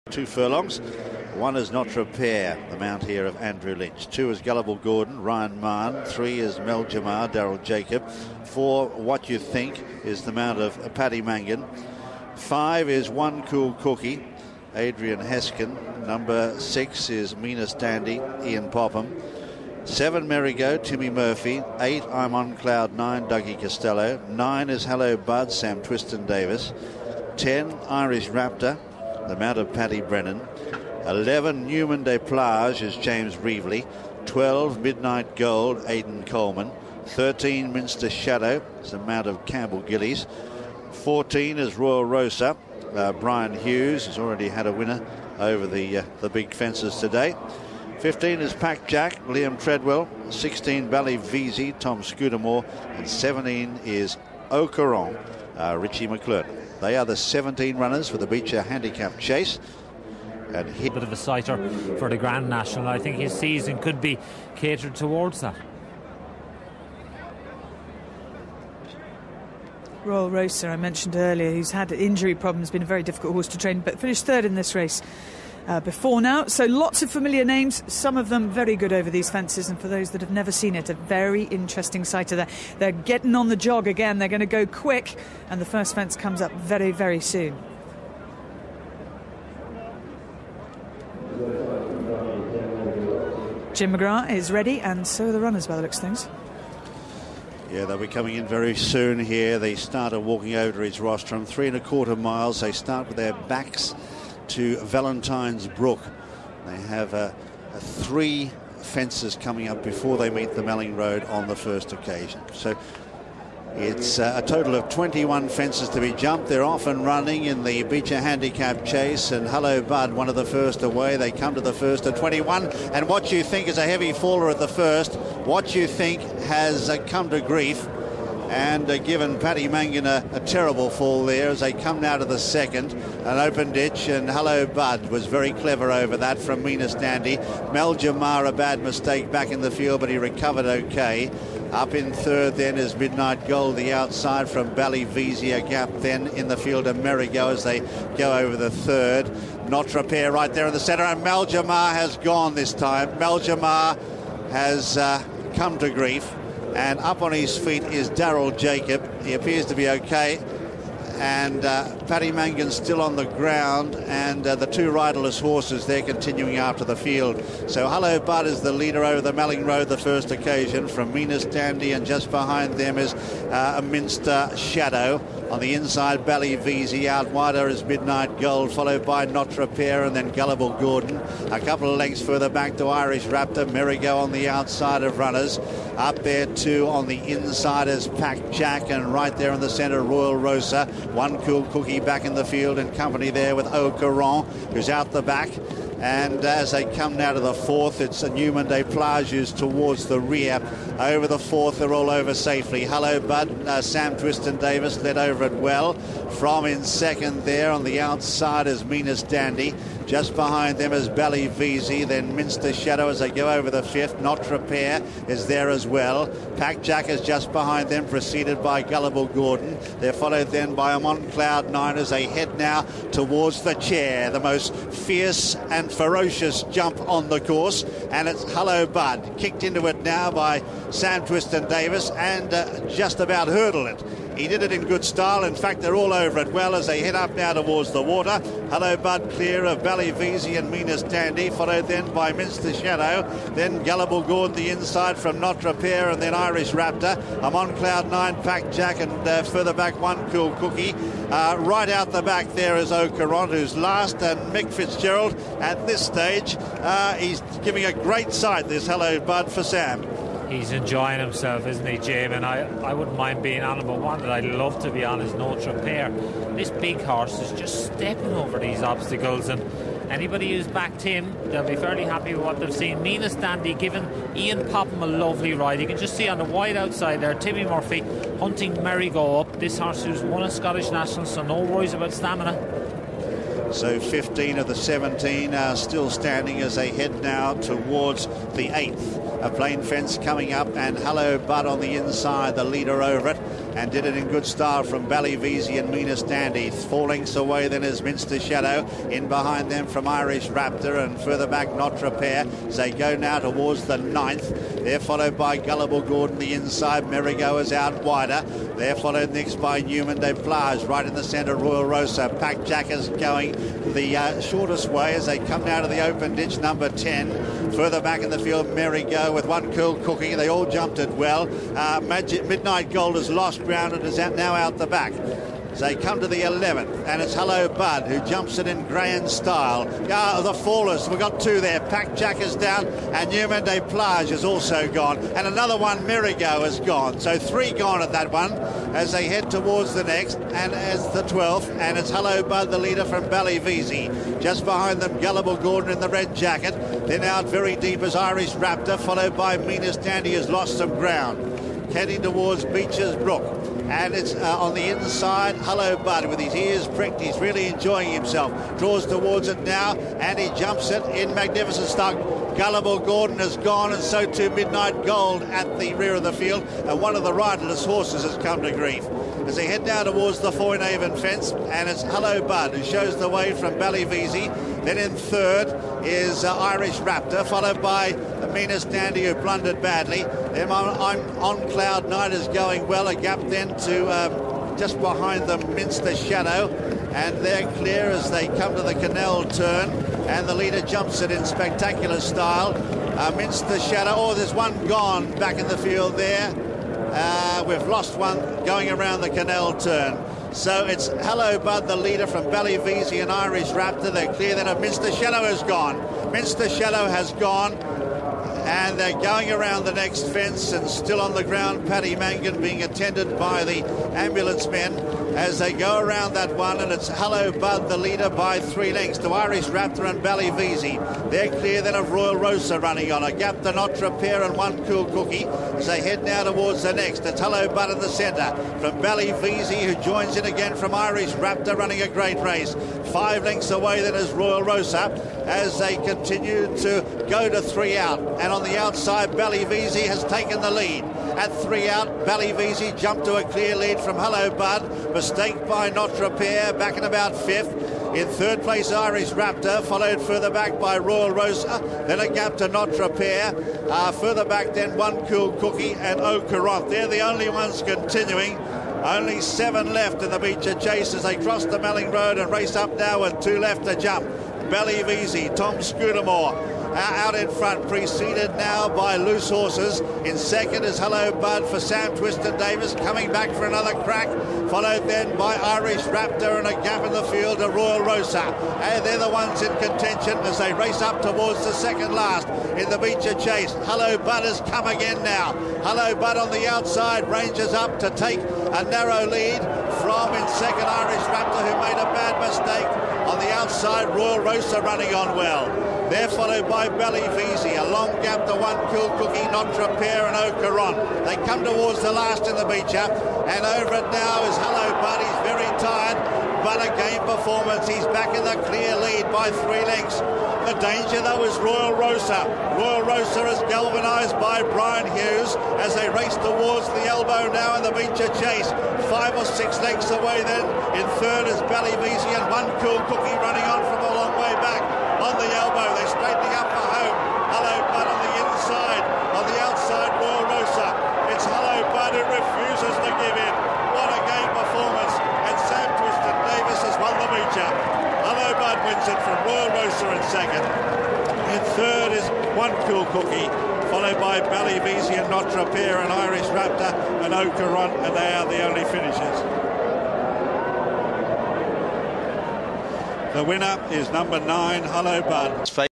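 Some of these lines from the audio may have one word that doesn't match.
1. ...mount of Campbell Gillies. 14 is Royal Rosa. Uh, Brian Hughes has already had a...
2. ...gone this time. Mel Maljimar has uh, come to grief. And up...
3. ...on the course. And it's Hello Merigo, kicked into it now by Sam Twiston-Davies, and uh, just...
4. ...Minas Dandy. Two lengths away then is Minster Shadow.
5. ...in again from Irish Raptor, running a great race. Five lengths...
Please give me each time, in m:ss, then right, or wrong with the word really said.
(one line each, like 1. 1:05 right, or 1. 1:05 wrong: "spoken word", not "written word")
1. 0:38 right
2. 2:32 right
3. 3:47 wrong: "Bud", not "Merigo"
4. 4:55 wrong: "Four", not "Two"
5. 7:10 right.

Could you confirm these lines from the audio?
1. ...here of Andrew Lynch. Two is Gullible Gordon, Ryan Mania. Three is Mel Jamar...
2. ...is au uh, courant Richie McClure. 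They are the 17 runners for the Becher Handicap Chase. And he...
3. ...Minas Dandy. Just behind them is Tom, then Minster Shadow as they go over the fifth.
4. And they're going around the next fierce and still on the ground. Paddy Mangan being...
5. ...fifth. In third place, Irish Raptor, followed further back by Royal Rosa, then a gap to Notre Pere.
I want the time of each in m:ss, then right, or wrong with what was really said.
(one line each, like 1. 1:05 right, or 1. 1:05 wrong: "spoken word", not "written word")
1. 0:03 right
2. 0:53 right
3. 3:28 wrong: "Ballyvesey", not "Tom"
4. 6:48 wrong: "fence", not "fierce"
5. 7:27 right.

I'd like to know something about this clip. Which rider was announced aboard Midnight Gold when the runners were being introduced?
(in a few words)
Aidan Coleman.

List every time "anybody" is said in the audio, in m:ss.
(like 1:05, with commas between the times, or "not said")
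4:30.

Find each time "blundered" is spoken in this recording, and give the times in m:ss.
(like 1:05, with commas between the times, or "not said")
6:19.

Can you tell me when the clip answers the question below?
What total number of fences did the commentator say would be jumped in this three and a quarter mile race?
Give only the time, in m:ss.
1:54.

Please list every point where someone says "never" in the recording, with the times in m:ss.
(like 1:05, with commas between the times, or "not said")
1:20.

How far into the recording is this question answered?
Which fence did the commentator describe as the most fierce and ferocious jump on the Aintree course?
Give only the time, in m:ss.
3:43.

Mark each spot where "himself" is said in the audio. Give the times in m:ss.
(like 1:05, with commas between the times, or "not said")
4:21, 5:58.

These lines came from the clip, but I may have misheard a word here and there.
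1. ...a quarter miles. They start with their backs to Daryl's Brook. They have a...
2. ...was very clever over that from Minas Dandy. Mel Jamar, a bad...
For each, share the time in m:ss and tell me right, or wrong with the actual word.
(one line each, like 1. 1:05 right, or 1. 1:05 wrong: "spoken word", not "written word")
1. 1:41 wrong: "Valentine", not "Daryl"
2. 2:15 right.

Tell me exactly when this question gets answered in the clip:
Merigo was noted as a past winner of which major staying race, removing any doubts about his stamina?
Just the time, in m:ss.
4:40.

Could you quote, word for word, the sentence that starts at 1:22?
They're getting on the jog again.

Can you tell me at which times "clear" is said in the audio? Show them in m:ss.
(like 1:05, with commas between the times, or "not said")
3:59, 6:27, 6:44, 7:01, 7:23, 8:28.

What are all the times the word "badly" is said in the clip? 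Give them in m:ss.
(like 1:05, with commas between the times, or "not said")
6:19.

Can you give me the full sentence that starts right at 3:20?
Over the fourth, they're all over safely.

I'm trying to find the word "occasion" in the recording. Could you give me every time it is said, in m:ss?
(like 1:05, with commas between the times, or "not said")
1:51, 2:50.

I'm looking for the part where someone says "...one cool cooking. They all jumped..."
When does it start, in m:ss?
5:19.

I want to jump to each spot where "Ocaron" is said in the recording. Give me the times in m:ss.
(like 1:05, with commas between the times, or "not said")
3:13, 8:20, 9:07.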